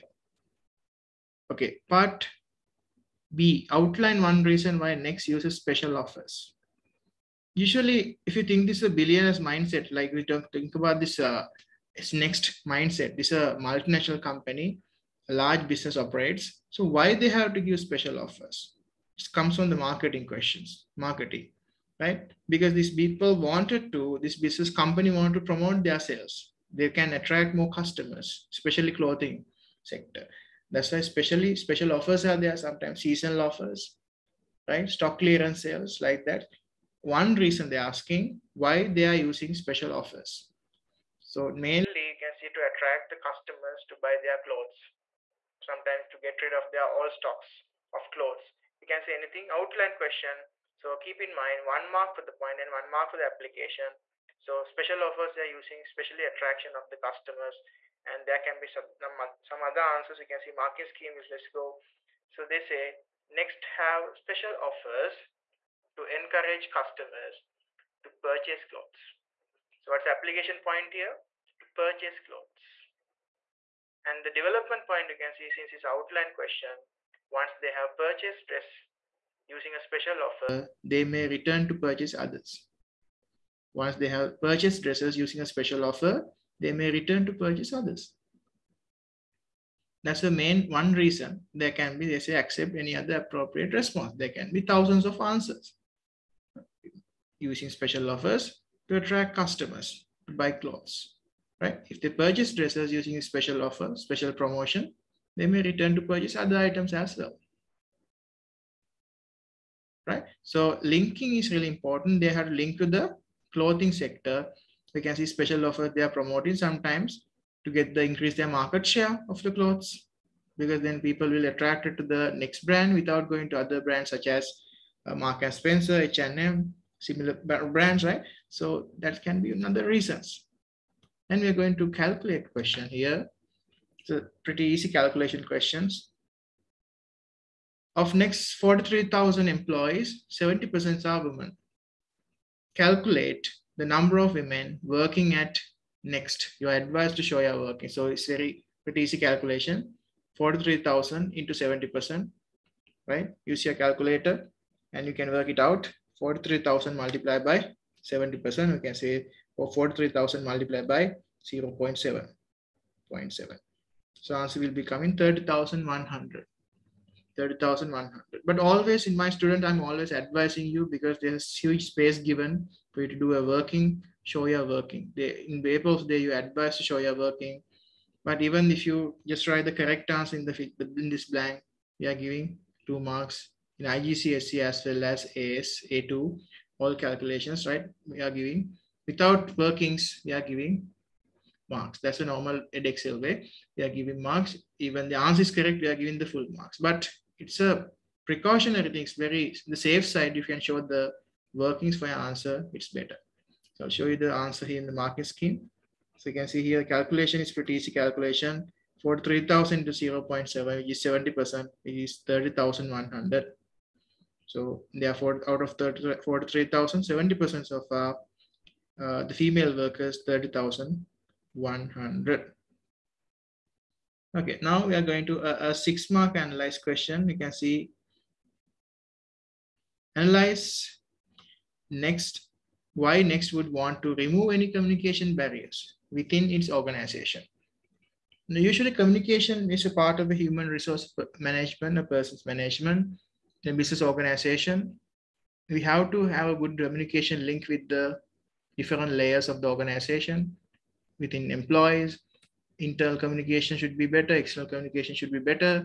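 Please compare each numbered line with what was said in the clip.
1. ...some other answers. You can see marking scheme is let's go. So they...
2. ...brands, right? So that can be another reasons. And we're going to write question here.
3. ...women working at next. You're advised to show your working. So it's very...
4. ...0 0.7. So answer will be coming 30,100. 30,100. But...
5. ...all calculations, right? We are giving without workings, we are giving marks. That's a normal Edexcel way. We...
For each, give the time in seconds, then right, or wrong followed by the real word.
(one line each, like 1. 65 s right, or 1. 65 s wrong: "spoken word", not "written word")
1. 59 s right
2. 127 s wrong: "calculate", not "write"
3. 144 s right
4. 161 s right
5. 186 s right.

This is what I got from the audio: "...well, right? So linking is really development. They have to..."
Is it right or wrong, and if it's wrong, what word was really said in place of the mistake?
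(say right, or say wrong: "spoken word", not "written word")
wrong: "important", not "development".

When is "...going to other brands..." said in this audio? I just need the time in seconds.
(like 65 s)
123 s.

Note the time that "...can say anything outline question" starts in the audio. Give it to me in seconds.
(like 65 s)
48 s.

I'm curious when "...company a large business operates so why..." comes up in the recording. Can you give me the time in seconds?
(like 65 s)
14 s.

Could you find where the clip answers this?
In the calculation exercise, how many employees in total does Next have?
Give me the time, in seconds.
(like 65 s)
138 s.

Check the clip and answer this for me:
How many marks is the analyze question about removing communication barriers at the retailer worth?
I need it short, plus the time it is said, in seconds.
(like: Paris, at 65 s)
6, at 225 s.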